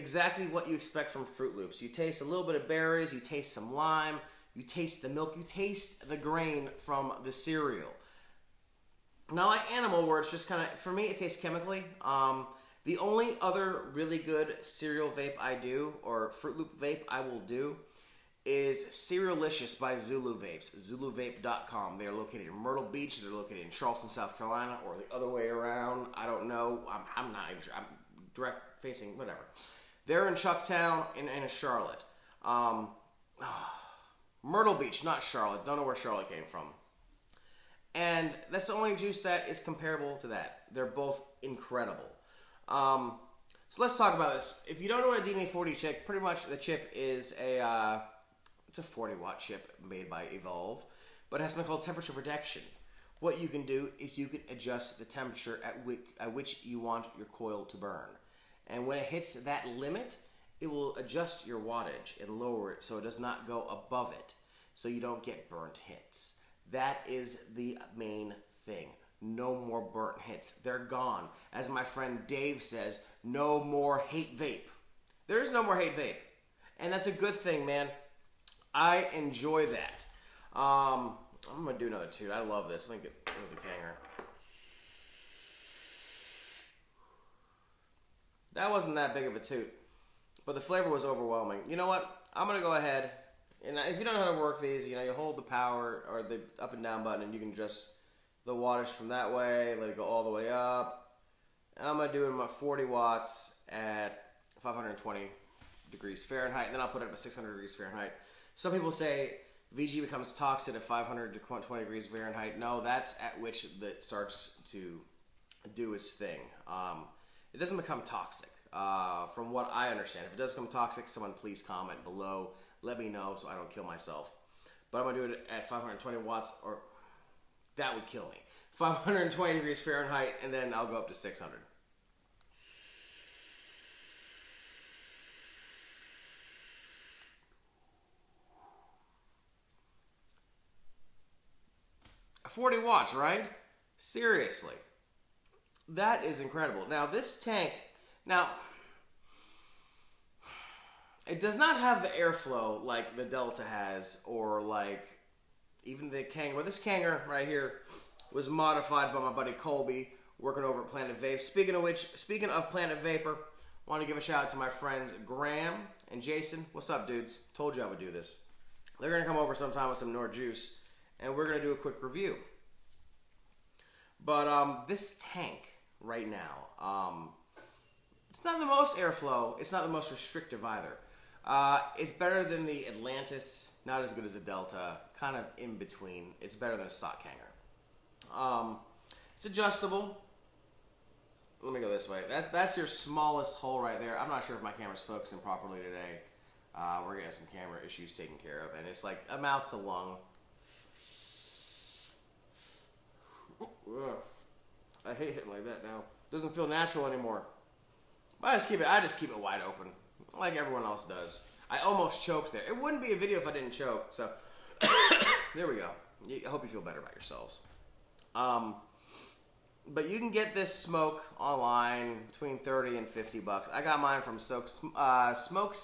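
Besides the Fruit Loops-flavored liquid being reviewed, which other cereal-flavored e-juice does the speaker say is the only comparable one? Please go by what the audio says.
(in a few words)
Cerealicious.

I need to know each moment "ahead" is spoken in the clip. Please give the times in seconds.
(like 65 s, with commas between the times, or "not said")
92 s.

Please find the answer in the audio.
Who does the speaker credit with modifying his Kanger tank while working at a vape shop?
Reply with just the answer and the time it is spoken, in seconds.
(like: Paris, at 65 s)
Colby, at 159 s.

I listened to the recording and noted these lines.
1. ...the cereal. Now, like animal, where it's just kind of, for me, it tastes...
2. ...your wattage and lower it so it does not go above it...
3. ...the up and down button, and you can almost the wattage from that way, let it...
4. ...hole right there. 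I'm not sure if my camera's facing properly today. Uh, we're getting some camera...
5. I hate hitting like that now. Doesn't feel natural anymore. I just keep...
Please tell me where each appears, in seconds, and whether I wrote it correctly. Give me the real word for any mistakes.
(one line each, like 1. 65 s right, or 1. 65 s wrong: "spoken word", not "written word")
1. 7 s right
2. 61 s right
3. 96 s wrong: "adjust", not "almost"
4. 193 s wrong: "focusing", not "facing"
5. 205 s right.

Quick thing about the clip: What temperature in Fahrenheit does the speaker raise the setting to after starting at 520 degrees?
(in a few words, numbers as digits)
600.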